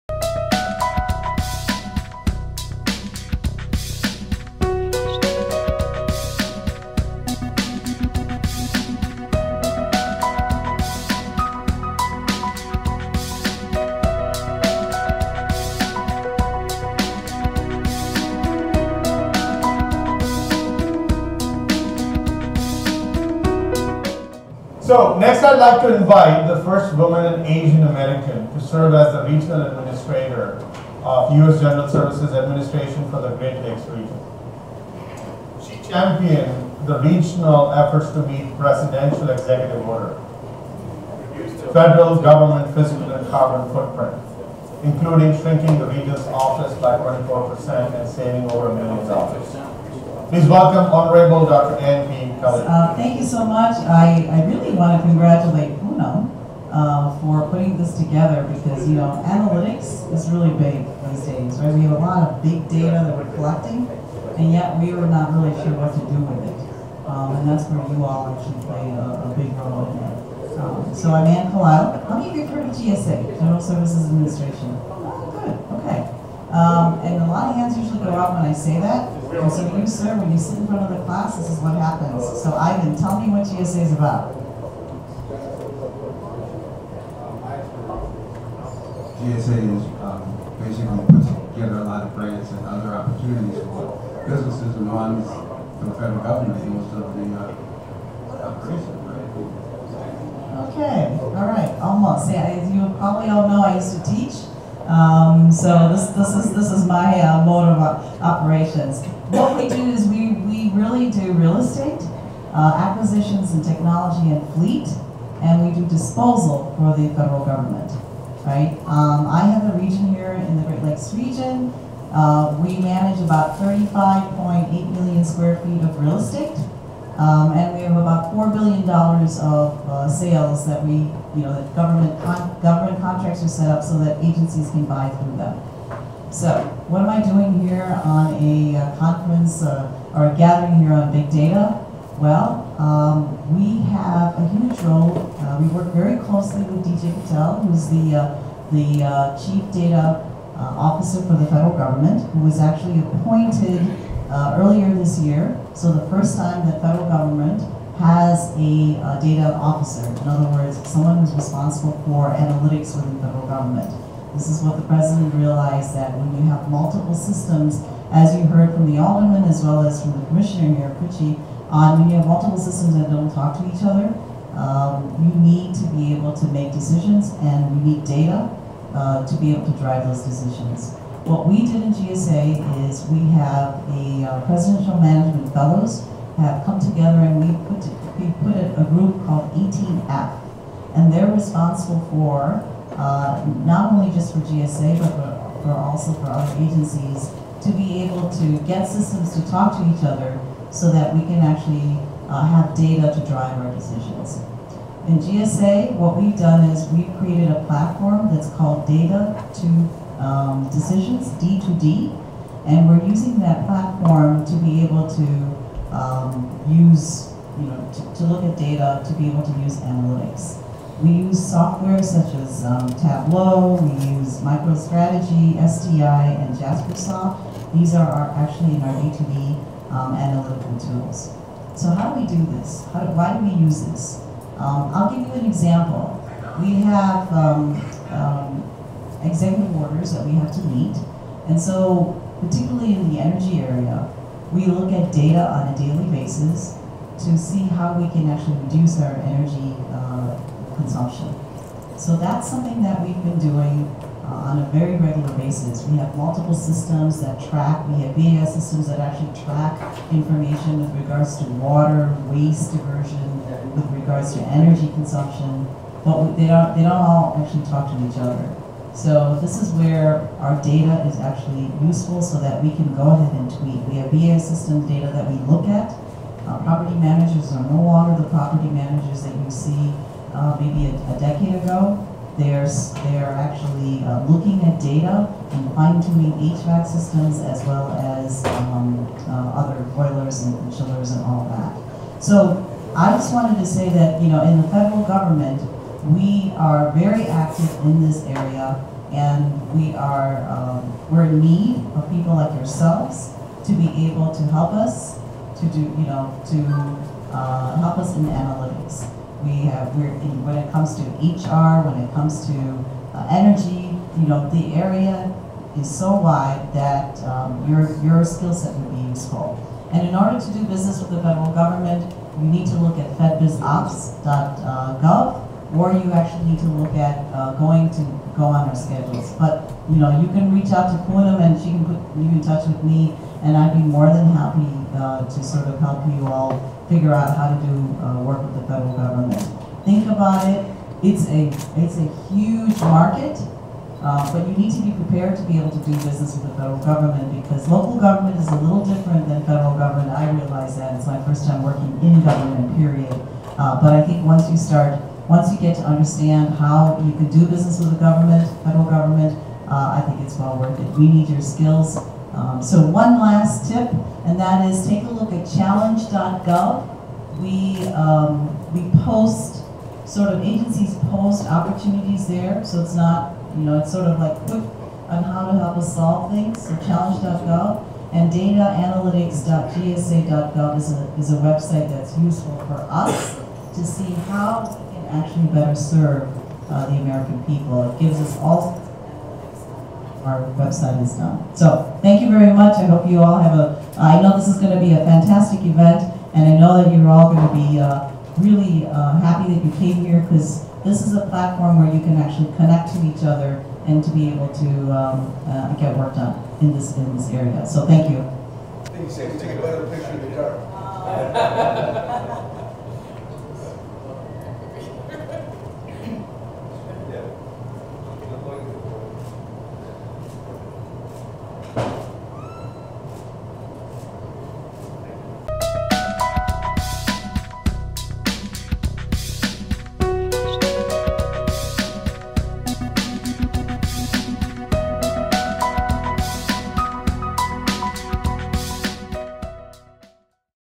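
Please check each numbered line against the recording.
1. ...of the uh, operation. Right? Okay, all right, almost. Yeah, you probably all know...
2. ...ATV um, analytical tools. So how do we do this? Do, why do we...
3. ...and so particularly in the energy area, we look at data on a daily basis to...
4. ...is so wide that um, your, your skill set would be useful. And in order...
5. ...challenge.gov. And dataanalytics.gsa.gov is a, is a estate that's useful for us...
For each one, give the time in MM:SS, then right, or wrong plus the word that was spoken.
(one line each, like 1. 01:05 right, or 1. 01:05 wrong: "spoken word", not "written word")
1. 01:36 right
2. 03:49 right
3. 04:01 right
4. 05:15 right
5. 06:16 wrong: "website", not "estate".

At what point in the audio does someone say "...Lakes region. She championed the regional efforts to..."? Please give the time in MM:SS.
00:33.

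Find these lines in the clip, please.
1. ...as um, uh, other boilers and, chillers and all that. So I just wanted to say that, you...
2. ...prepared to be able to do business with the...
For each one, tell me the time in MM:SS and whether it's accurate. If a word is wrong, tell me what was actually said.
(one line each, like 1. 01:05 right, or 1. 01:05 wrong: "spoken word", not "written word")
1. 04:48 right
2. 05:44 right.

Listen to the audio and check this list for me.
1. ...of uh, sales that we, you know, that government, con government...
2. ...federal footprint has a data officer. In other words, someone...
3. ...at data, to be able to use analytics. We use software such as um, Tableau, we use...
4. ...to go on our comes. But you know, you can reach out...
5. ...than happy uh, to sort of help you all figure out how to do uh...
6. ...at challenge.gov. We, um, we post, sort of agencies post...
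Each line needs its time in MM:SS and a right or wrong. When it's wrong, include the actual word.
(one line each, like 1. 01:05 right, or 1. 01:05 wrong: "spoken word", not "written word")
1. 02:08 right
2. 02:36 wrong: "government", not "footprint"
3. 03:38 right
4. 05:27 wrong: "schedules", not "comes"
5. 05:34 right
6. 06:05 right.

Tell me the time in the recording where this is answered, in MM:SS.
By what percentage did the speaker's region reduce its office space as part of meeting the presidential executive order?
00:46.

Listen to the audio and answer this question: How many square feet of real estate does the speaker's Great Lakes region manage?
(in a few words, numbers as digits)
35.8 million.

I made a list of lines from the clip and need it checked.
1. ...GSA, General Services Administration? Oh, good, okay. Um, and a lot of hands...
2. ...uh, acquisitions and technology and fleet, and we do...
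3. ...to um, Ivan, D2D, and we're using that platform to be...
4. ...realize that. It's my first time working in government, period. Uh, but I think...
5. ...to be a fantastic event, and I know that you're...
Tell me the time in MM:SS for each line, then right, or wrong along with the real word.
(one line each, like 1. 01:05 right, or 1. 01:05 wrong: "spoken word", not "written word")
1. 01:12 right
2. 01:52 right
3. 03:29 wrong: "Decisions", not "Ivan"
4. 05:50 right
5. 06:34 right.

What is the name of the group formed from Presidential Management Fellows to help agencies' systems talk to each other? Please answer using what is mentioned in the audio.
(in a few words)
18F.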